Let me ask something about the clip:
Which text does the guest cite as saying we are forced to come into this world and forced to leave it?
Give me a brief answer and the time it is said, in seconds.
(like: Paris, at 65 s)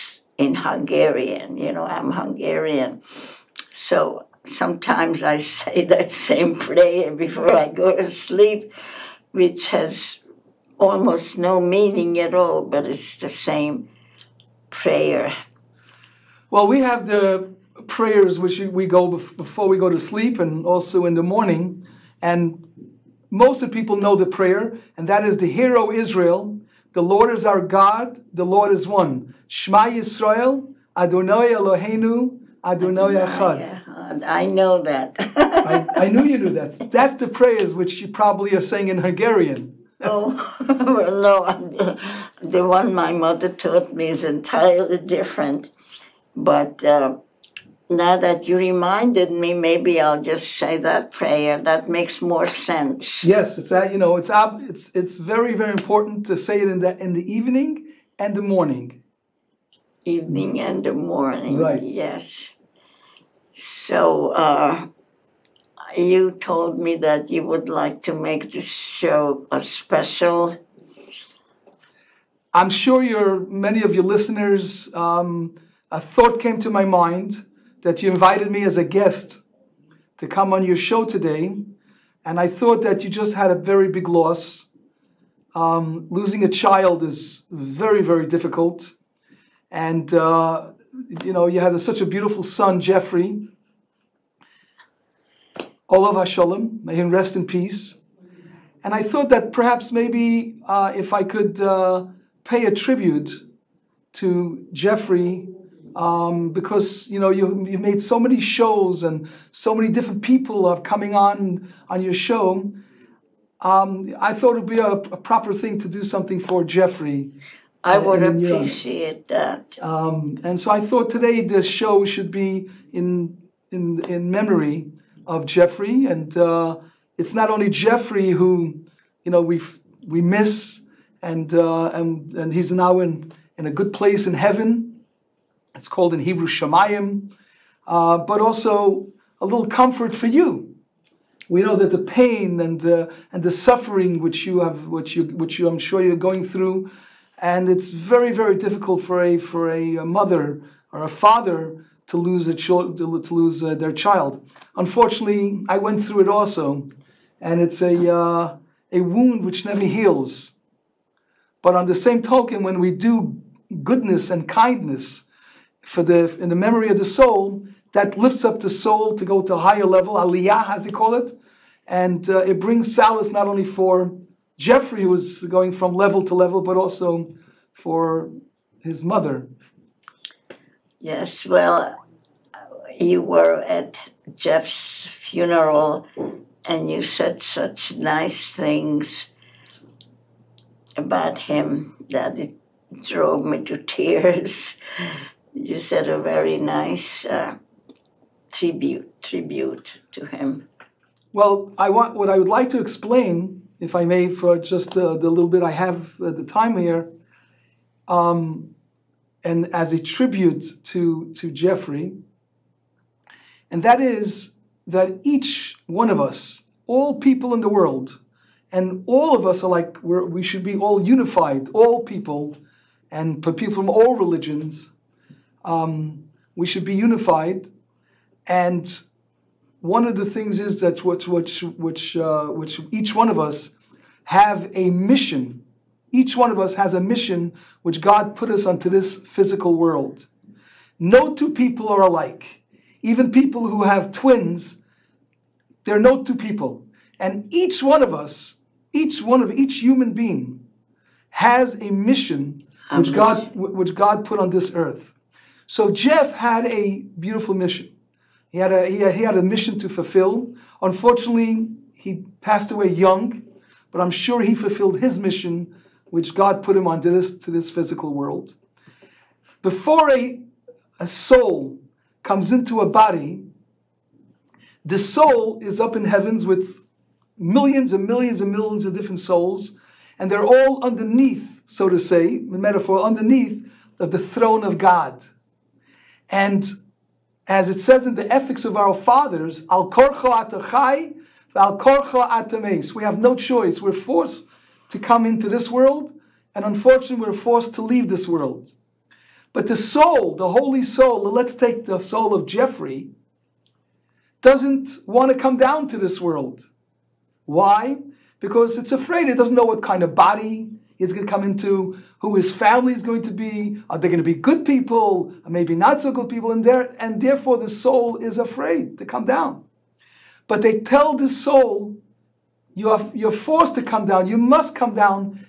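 Ethics of our Fathers, at 288 s.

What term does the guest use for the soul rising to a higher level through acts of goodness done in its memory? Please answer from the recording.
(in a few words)
aliyah.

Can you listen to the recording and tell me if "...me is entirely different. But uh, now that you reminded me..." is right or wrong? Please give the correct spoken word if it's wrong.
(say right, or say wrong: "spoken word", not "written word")
right.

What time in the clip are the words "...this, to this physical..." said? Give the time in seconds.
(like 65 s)
267 s.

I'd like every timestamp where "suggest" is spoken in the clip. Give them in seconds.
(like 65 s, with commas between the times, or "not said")
not said.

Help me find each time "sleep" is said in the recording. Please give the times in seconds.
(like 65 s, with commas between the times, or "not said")
8 s, 19 s.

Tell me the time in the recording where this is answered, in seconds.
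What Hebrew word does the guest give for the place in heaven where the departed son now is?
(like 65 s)
136 s.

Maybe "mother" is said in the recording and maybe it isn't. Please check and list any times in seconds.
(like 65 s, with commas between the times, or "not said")
43 s, 150 s, 179 s.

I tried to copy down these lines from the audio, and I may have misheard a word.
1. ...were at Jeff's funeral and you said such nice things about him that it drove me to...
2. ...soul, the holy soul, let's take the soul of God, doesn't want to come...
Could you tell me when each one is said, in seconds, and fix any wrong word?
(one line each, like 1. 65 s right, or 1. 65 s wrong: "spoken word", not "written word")
1. 183 s right
2. 299 s wrong: "Jeffrey", not "God".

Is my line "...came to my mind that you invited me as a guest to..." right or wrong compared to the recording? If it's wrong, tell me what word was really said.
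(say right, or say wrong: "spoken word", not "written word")
right.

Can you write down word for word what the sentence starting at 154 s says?
Unfortunately, I went through it also, and it's a uh, a wound which never heals.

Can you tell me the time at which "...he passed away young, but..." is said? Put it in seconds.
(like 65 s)
261 s.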